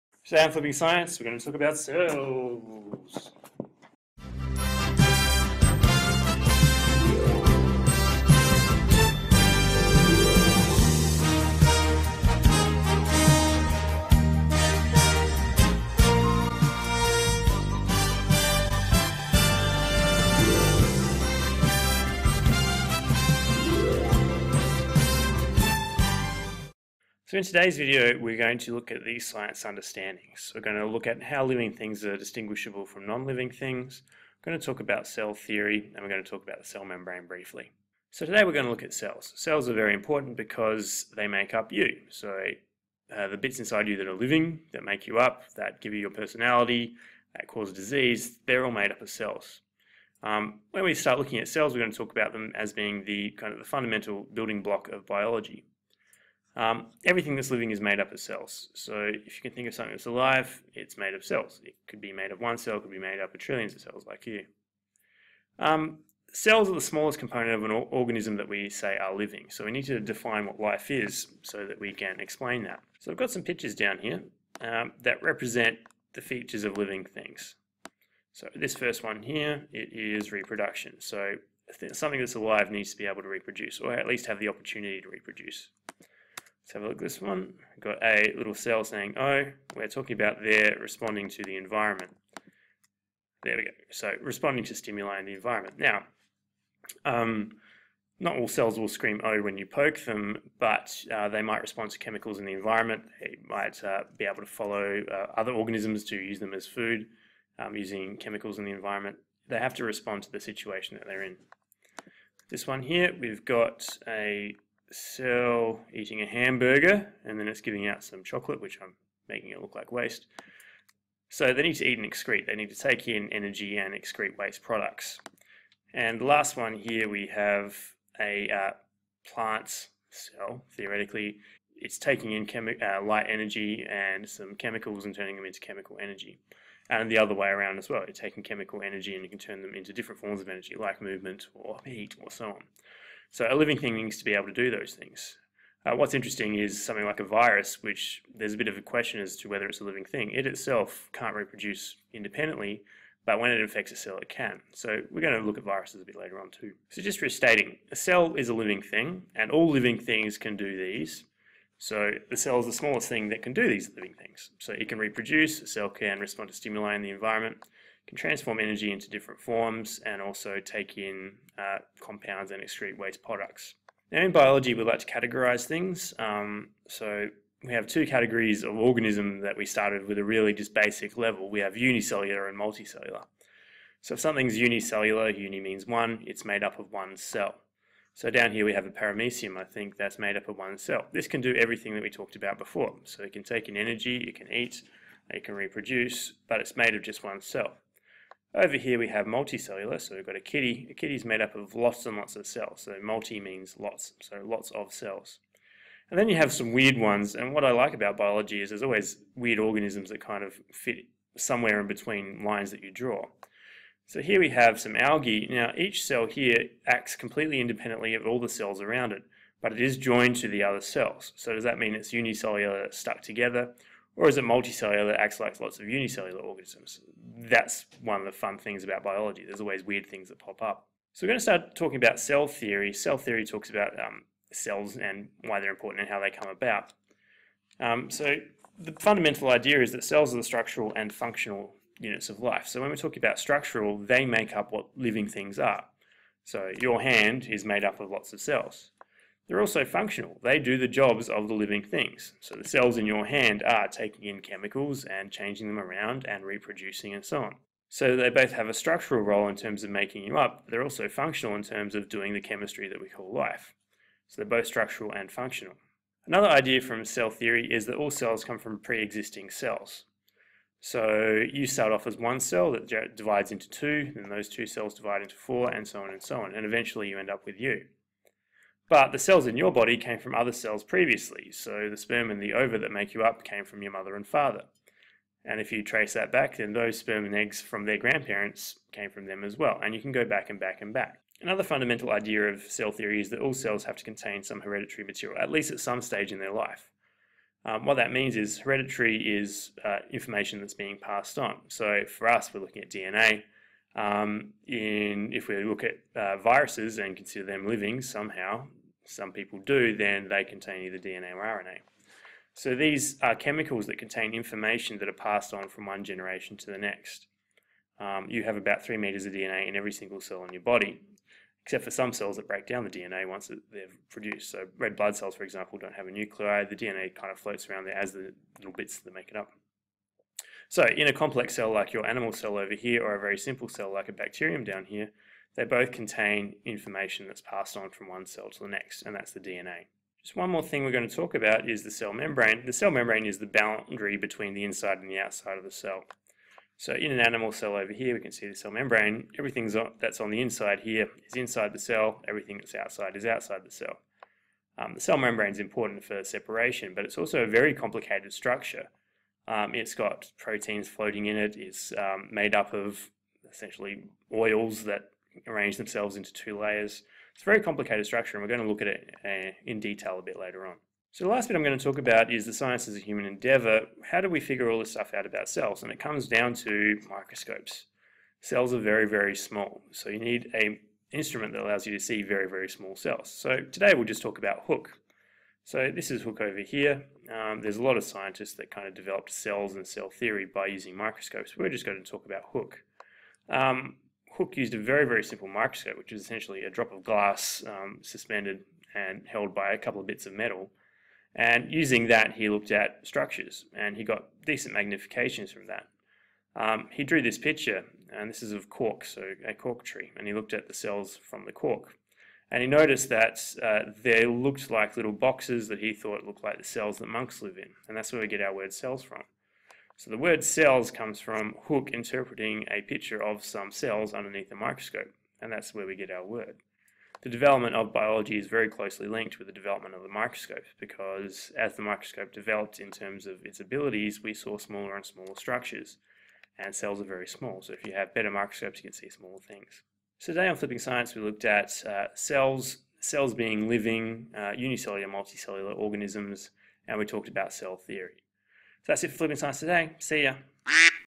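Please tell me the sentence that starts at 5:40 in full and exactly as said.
Just one more thing we're going to talk about is the cell membrane.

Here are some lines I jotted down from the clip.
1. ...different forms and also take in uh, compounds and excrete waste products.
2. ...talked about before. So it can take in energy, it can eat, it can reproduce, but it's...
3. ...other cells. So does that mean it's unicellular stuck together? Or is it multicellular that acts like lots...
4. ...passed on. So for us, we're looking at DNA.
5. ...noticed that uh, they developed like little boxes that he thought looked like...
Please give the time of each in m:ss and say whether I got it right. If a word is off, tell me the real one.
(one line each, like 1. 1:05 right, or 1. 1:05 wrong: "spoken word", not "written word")
1. 2:49 right
2. 3:12 right
3. 3:40 right
4. 5:01 right
5. 6:52 wrong: "looked", not "developed".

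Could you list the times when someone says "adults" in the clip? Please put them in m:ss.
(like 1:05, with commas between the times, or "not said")
not said.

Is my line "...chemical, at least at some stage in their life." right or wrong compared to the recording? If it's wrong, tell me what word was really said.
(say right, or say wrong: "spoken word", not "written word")
wrong: "material", not "chemical".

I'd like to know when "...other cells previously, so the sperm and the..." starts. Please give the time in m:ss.
4:40.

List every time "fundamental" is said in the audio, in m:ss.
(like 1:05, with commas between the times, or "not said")
0:53, 3:58, 4:51.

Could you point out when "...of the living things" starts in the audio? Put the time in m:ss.
4:11.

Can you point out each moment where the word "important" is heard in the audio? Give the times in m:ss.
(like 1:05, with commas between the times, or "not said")
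0:39, 3:55, 5:55.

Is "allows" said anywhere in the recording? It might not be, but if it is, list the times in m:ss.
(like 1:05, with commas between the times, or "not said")
6:21.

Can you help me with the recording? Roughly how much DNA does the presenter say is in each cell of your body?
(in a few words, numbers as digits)
3 meters.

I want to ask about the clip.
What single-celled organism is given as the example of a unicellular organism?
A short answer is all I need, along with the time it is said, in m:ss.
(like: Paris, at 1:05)
paramecium, at 3:08.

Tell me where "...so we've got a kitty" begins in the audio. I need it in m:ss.
3:20.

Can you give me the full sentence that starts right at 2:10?
Theoretically, it's taking in uh, light energy and some chemicals and turning them into chemical energy.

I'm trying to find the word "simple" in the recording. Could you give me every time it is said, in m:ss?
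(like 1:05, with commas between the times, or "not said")
5:33, 6:35.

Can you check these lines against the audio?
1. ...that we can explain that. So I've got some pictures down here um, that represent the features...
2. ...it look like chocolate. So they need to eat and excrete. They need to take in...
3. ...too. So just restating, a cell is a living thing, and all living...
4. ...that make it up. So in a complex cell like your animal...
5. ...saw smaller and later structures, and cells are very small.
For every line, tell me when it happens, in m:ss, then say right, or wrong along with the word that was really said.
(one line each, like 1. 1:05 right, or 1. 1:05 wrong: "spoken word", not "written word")
1. 1:11 right
2. 1:59 wrong: "waste", not "chocolate"
3. 2:36 right
4. 5:28 right
5. 7:14 wrong: "smaller", not "later".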